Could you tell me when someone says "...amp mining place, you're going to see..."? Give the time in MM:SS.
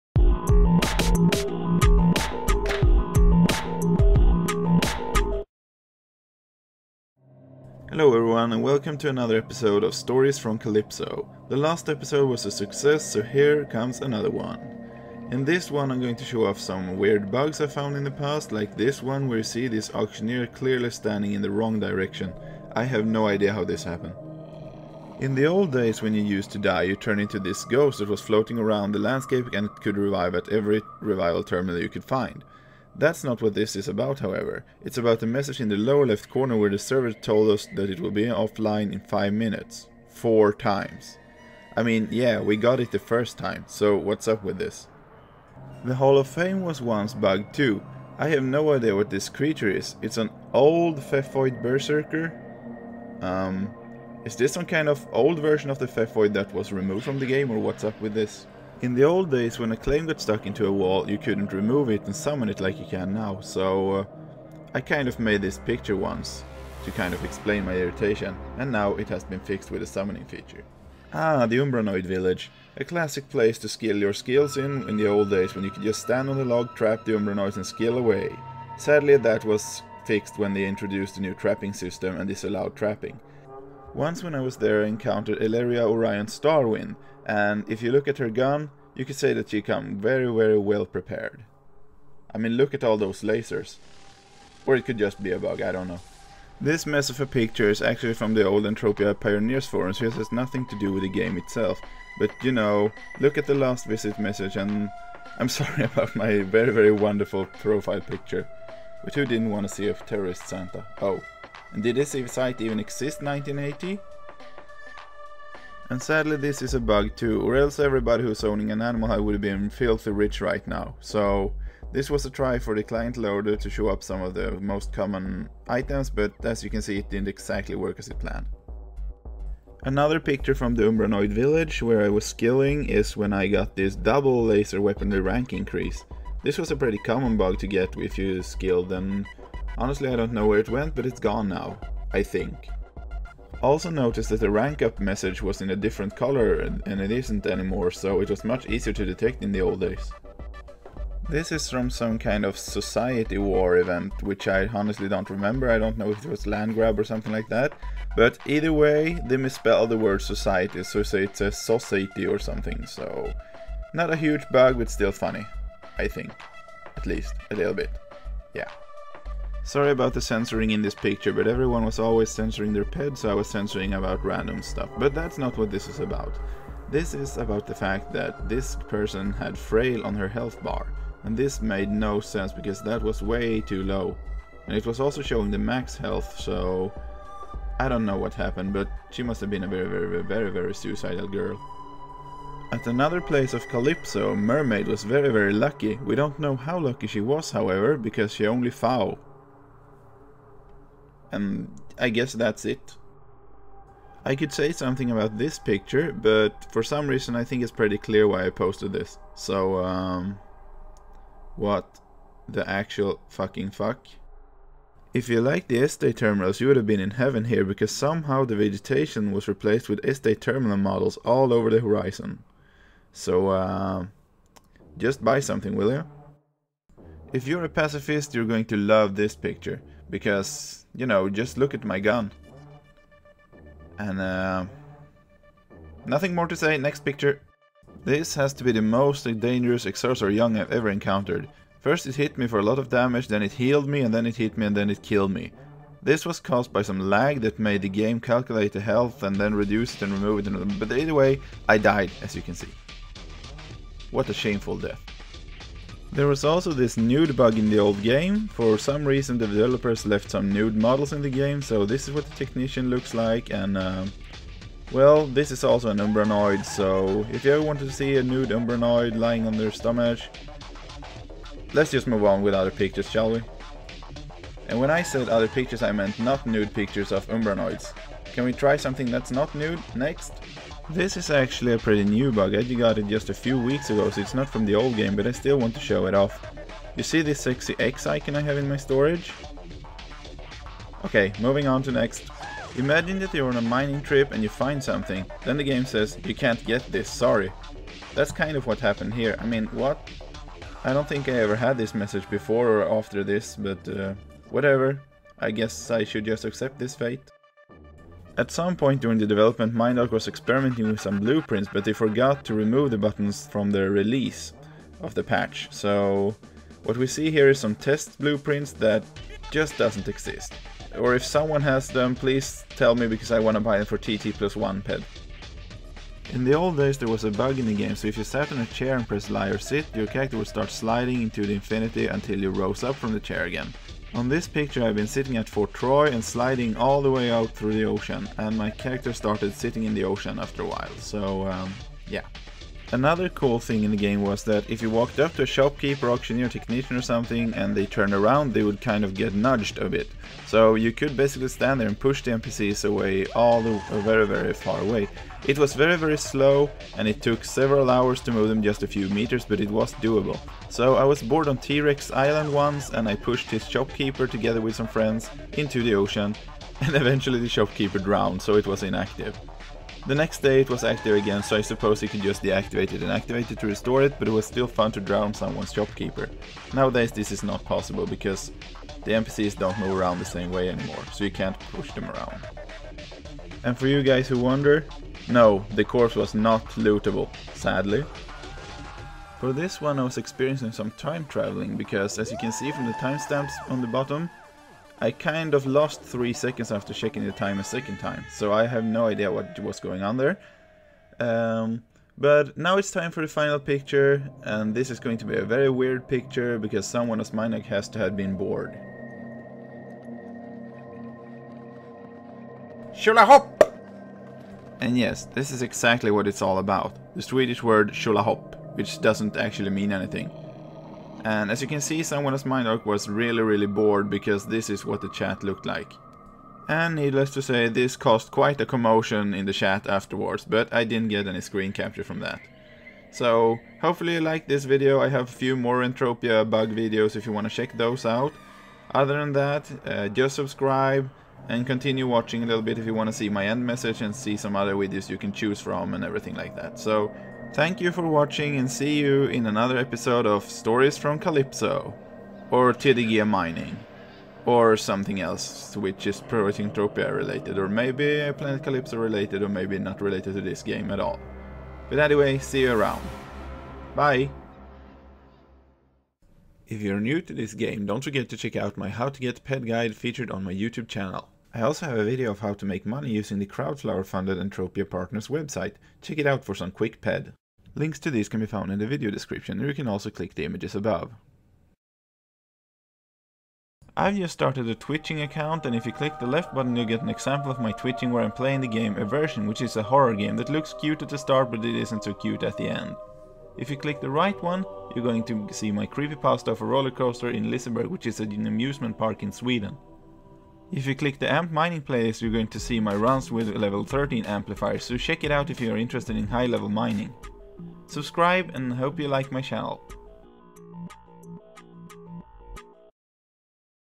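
08:21.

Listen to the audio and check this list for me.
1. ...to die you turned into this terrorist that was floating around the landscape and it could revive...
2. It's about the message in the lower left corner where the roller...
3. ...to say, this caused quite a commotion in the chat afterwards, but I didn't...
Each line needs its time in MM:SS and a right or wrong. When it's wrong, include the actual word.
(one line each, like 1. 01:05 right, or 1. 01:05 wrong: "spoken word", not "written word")
1. 00:26 wrong: "ghost", not "terrorist"
2. 00:34 wrong: "server", not "roller"
3. 07:07 right.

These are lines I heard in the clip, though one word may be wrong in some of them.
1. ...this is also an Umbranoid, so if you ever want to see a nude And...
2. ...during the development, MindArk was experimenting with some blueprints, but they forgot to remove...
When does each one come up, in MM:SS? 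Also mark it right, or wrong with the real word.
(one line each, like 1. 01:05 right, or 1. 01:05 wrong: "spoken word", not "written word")
1. 04:25 wrong: "Umbranoid", not "And"
2. 05:09 right.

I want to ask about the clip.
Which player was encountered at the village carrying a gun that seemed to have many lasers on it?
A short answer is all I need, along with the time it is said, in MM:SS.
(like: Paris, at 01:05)
Elaria Orion Starwind, at 01:25.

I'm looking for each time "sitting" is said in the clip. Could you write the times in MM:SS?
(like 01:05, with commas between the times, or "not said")
05:35, 05:39.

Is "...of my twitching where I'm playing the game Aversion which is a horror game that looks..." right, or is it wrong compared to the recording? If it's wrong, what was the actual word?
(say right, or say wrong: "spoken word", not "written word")
right.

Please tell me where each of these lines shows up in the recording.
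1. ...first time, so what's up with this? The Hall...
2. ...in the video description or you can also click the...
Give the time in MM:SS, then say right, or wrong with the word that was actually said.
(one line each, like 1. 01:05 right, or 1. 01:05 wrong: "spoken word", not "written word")
1. 00:42 right
2. 07:58 right.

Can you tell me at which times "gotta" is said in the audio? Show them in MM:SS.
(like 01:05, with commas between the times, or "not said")
not said.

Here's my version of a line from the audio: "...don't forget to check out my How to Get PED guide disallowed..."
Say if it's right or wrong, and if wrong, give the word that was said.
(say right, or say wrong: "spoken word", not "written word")
wrong: "featured", not "disallowed".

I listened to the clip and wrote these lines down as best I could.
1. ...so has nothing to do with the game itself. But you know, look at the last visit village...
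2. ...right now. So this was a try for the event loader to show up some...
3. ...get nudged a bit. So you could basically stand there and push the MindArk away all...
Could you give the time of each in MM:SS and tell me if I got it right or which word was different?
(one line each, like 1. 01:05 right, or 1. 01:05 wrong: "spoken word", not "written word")
1. 01:39 wrong: "message", not "village"
2. 02:00 wrong: "client", not "event"
3. 05:49 wrong: "NPCs", not "MindArk".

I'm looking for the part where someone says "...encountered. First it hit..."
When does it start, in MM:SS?
04:00.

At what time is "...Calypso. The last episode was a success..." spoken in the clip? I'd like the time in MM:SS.
00:10.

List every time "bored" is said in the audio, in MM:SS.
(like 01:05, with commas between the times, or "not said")
06:01, 06:48, 07:03.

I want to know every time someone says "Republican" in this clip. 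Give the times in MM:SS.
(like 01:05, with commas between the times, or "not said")
not said.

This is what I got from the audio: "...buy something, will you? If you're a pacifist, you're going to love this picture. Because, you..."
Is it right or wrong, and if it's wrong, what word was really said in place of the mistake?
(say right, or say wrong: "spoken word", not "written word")
right.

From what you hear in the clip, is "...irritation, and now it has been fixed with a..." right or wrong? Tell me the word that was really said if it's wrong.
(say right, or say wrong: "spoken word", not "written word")
right.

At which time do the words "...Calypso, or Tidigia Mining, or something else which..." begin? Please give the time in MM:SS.
07:31.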